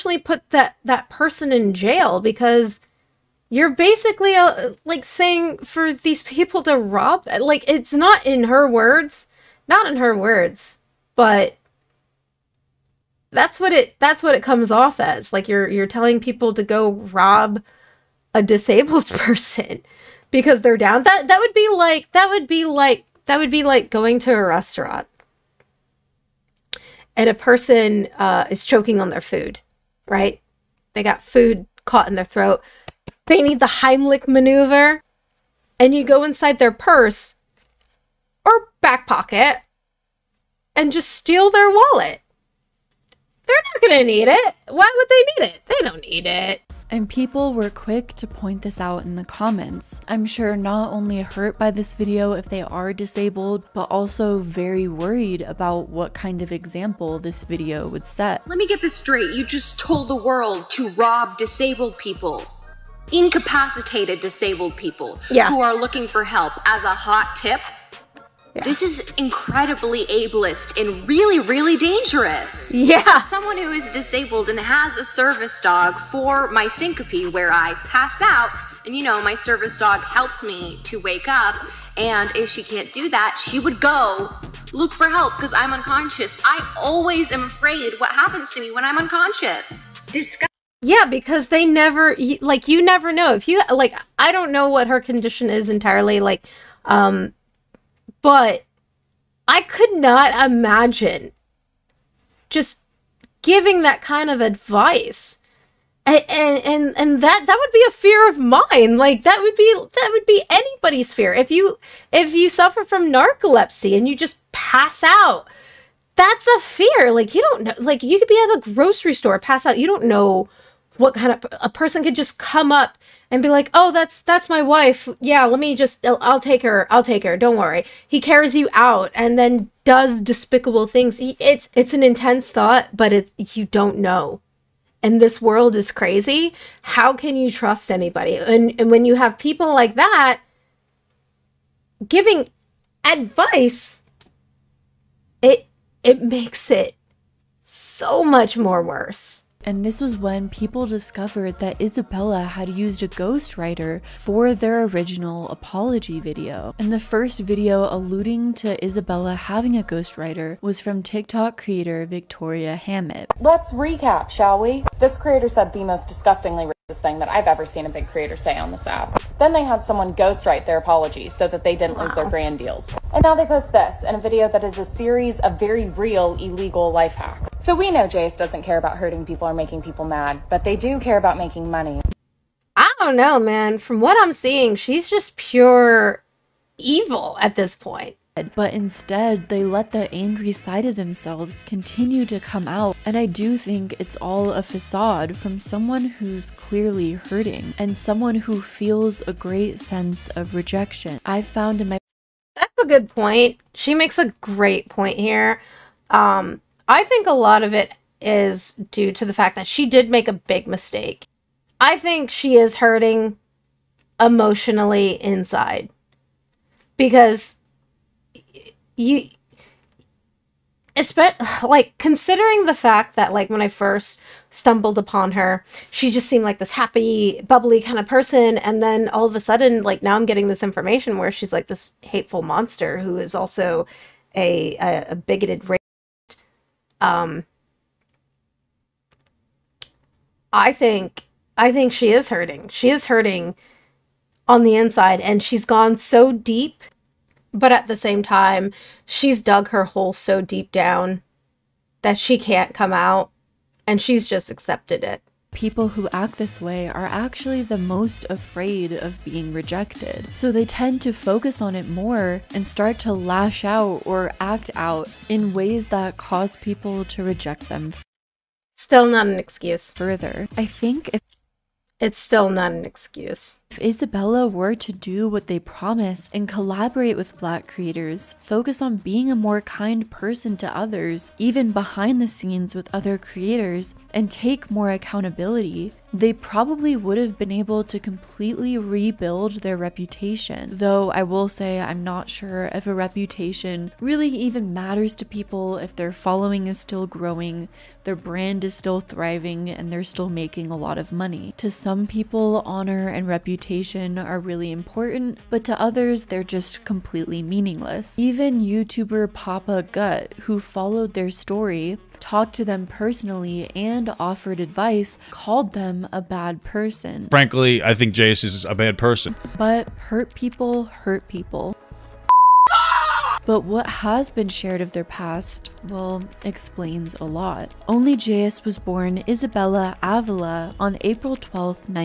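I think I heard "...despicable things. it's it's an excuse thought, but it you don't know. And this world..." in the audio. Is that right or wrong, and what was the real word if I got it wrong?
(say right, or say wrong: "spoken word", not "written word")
wrong: "intense", not "excuse".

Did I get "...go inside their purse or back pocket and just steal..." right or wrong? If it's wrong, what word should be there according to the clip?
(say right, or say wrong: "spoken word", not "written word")
right.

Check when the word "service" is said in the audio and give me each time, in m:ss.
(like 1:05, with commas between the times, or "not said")
1:15, 1:19.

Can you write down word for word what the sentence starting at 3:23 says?
She makes a great point here.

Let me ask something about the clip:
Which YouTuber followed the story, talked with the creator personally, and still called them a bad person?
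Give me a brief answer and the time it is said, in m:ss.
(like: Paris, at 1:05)
Papa Gut, at 5:09.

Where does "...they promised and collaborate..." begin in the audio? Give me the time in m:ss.
4:35.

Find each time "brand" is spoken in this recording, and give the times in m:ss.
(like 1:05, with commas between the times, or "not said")
2:52, 4:58.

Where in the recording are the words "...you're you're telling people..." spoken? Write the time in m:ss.
0:15.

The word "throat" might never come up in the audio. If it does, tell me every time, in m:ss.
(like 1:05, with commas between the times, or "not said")
0:32.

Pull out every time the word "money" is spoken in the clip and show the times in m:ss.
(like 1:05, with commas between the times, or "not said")
3:01, 5:01.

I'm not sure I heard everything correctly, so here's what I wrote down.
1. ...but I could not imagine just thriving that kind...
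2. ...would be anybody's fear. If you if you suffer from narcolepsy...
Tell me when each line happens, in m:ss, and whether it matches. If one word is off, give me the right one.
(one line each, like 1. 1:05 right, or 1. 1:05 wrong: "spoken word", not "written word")
1. 1:38 wrong: "giving", not "thriving"
2. 1:50 right.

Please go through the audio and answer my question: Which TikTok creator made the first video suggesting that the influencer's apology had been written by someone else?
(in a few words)
Victoria Hammett.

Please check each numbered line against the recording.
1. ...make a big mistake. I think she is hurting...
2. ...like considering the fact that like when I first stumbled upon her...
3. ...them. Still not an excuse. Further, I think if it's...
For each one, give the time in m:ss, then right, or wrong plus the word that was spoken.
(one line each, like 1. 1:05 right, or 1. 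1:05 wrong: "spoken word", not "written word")
1. 3:30 right
2. 3:41 right
3. 4:27 right.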